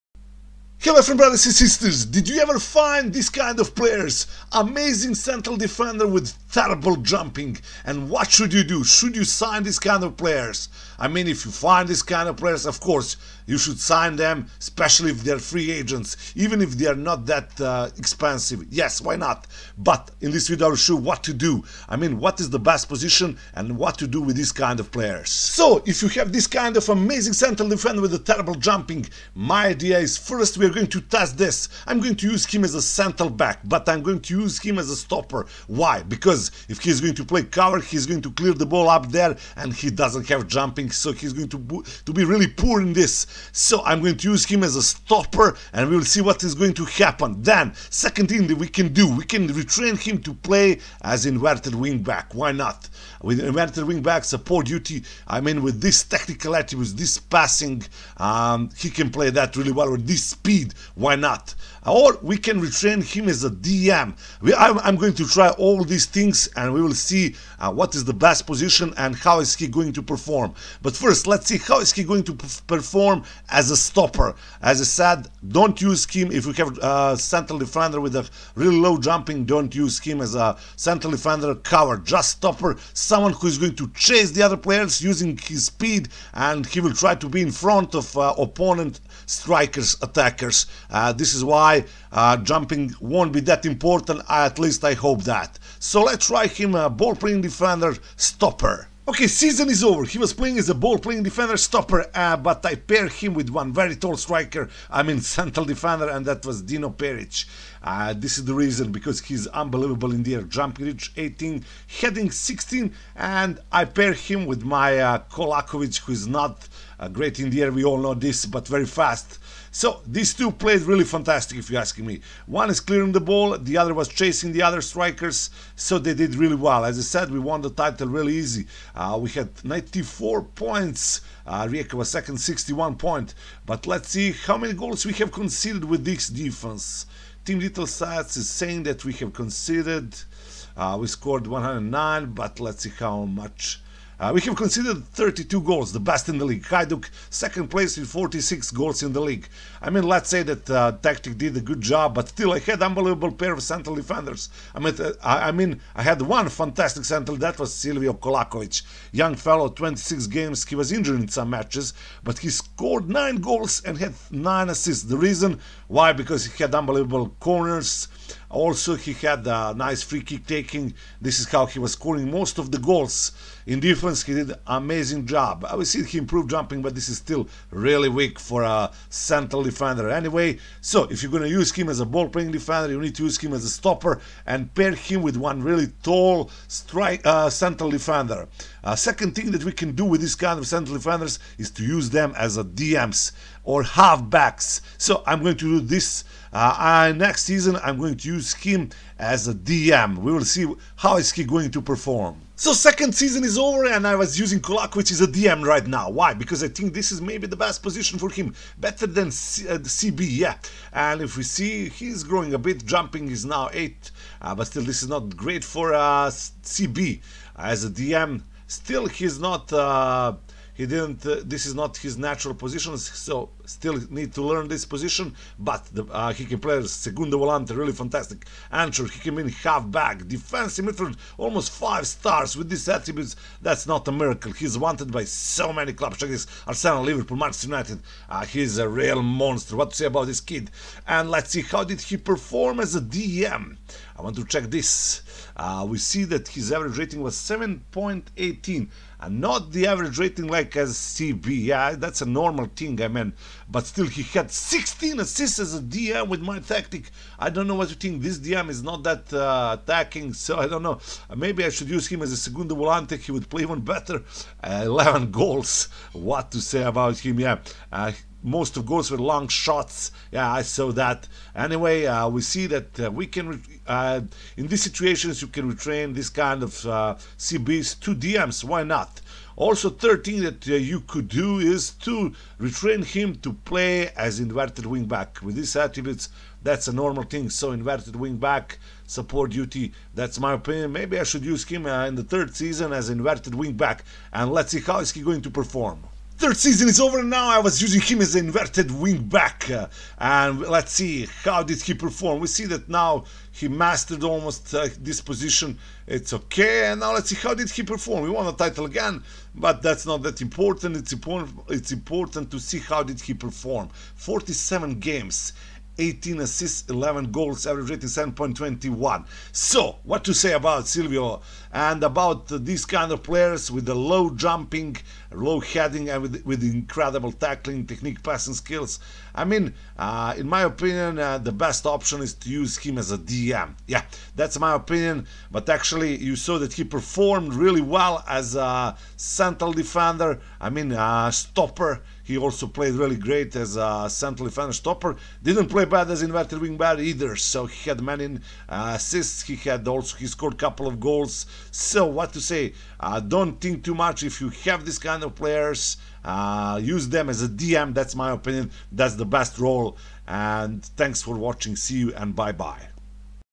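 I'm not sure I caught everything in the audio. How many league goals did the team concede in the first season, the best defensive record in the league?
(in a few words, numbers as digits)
32.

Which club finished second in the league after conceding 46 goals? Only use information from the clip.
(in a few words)
Hajduk.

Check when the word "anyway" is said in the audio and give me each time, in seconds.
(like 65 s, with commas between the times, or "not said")
180 s, 271 s.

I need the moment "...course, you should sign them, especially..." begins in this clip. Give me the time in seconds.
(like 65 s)
12 s.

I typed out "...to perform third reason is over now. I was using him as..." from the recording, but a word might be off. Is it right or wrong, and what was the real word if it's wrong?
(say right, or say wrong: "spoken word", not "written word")
wrong: "season", not "reason".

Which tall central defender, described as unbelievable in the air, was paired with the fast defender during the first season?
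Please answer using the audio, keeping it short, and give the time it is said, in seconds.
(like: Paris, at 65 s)
Dino Peric, at 106 s.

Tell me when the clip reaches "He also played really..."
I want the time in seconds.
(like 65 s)
342 s.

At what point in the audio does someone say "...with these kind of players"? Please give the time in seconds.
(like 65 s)
24 s.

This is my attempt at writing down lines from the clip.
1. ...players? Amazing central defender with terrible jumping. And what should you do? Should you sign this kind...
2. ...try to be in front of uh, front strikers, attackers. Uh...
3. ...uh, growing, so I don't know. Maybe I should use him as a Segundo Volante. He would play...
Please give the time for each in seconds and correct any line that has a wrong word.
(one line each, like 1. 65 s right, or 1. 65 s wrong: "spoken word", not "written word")
1. 3 s right
2. 86 s wrong: "opponent", not "front"
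3. 259 s wrong: "attacking", not "growing".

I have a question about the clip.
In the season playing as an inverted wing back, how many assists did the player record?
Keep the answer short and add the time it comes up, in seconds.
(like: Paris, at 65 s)
18, at 315 s.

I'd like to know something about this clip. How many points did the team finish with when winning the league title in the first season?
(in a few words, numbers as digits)
94.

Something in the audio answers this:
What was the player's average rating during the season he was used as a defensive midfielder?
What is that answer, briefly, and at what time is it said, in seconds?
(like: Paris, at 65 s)
7.18, at 247 s.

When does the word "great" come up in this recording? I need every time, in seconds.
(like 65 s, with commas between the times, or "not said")
117 s, 215 s, 343 s.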